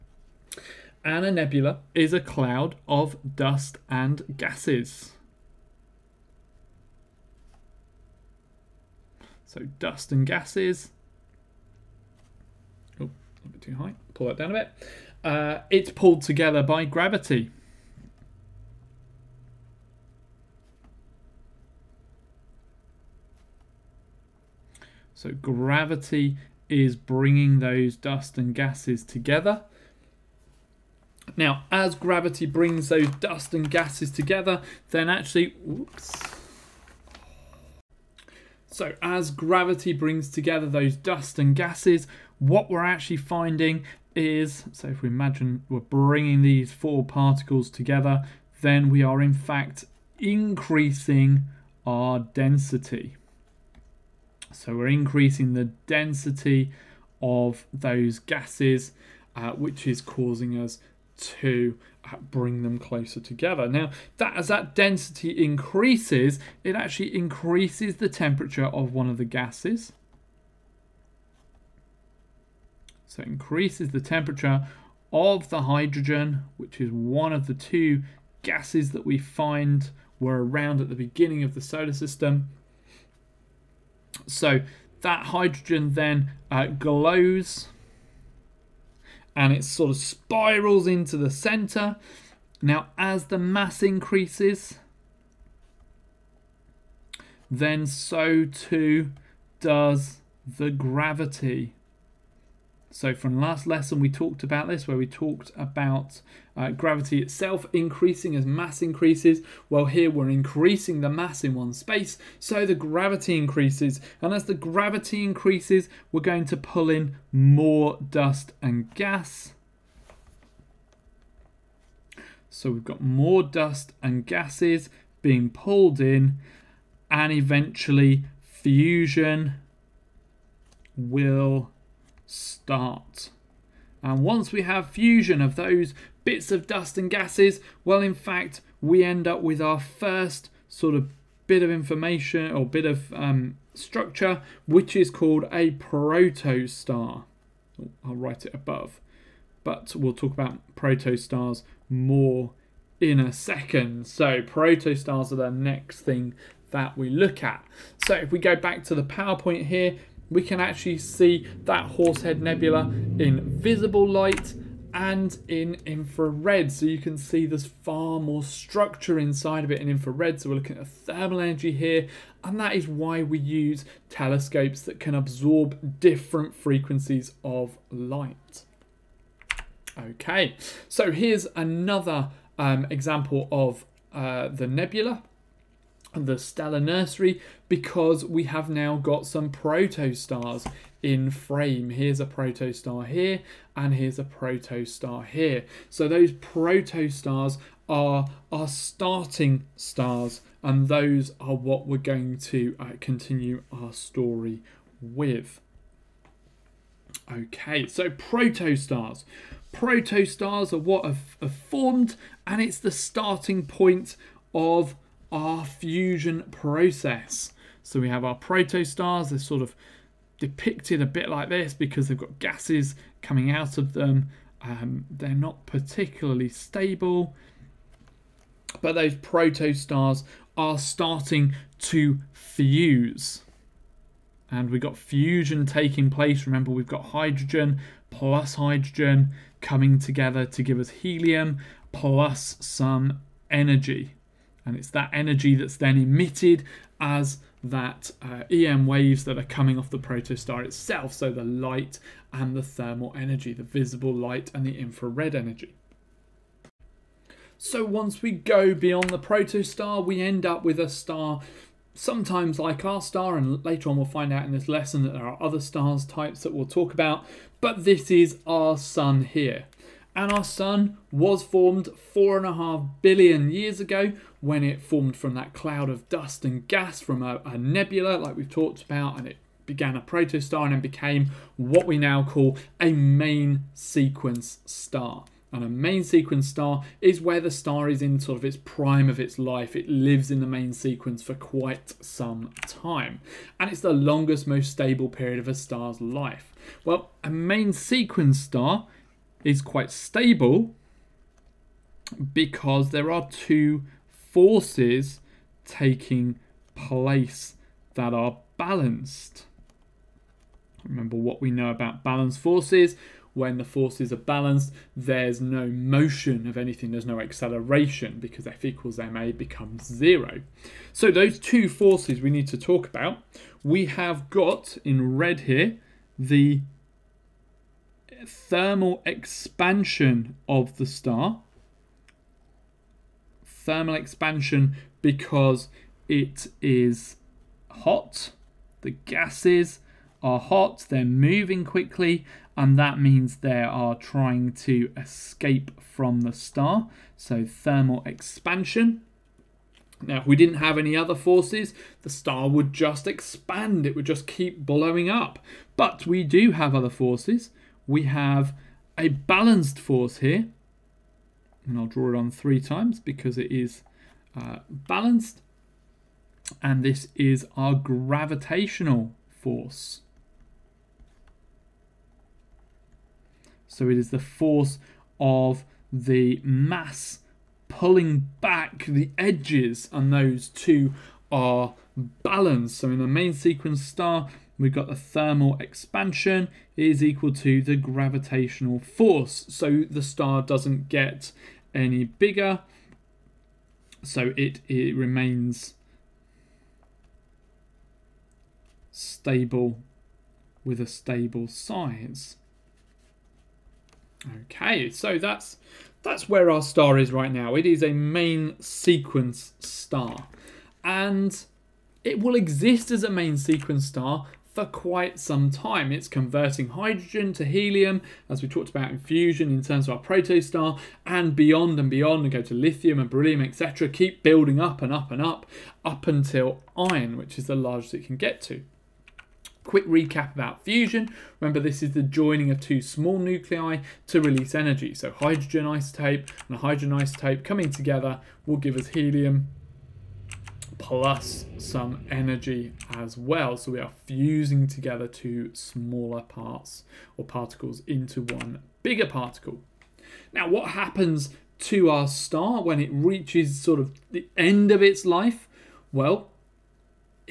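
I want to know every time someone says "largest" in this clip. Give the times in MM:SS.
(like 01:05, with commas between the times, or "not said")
07:07.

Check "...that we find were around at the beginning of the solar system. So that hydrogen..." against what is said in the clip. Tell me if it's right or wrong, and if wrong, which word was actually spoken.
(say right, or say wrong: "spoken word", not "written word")
right.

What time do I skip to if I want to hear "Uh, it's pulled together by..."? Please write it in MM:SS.
00:15.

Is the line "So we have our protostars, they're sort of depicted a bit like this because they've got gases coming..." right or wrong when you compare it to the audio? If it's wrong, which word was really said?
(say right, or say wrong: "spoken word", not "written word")
right.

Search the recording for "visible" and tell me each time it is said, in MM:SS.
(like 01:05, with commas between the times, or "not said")
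02:43, 04:13.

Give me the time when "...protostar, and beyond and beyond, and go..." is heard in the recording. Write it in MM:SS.
07:00.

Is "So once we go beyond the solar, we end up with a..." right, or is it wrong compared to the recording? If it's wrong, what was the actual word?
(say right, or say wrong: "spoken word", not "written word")
wrong: "protostar", not "solar".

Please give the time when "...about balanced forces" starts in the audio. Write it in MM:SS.
05:11.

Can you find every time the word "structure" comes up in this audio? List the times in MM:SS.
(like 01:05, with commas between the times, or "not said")
02:23, 02:48.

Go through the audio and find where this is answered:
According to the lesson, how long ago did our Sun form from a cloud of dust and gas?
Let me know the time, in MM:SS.
04:32.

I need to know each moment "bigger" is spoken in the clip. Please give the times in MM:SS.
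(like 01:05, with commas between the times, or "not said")
06:32, 07:28.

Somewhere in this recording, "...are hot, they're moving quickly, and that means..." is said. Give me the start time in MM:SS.
05:40.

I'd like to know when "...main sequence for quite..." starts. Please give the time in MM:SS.
04:50.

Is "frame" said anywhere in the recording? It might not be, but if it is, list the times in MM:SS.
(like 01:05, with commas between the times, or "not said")
03:11.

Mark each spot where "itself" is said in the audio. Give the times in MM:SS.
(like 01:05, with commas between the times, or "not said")
01:47, 04:10.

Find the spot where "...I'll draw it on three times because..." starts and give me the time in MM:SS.
06:01.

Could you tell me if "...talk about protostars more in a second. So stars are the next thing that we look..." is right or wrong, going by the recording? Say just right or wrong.
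wrong.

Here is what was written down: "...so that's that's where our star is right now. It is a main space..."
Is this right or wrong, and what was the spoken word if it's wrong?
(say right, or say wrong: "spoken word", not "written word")
wrong: "sequence", not "space".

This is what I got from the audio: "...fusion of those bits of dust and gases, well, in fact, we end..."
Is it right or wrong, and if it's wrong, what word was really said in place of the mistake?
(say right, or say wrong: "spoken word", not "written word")
right.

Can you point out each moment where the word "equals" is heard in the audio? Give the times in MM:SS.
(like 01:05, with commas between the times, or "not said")
05:18, 06:27.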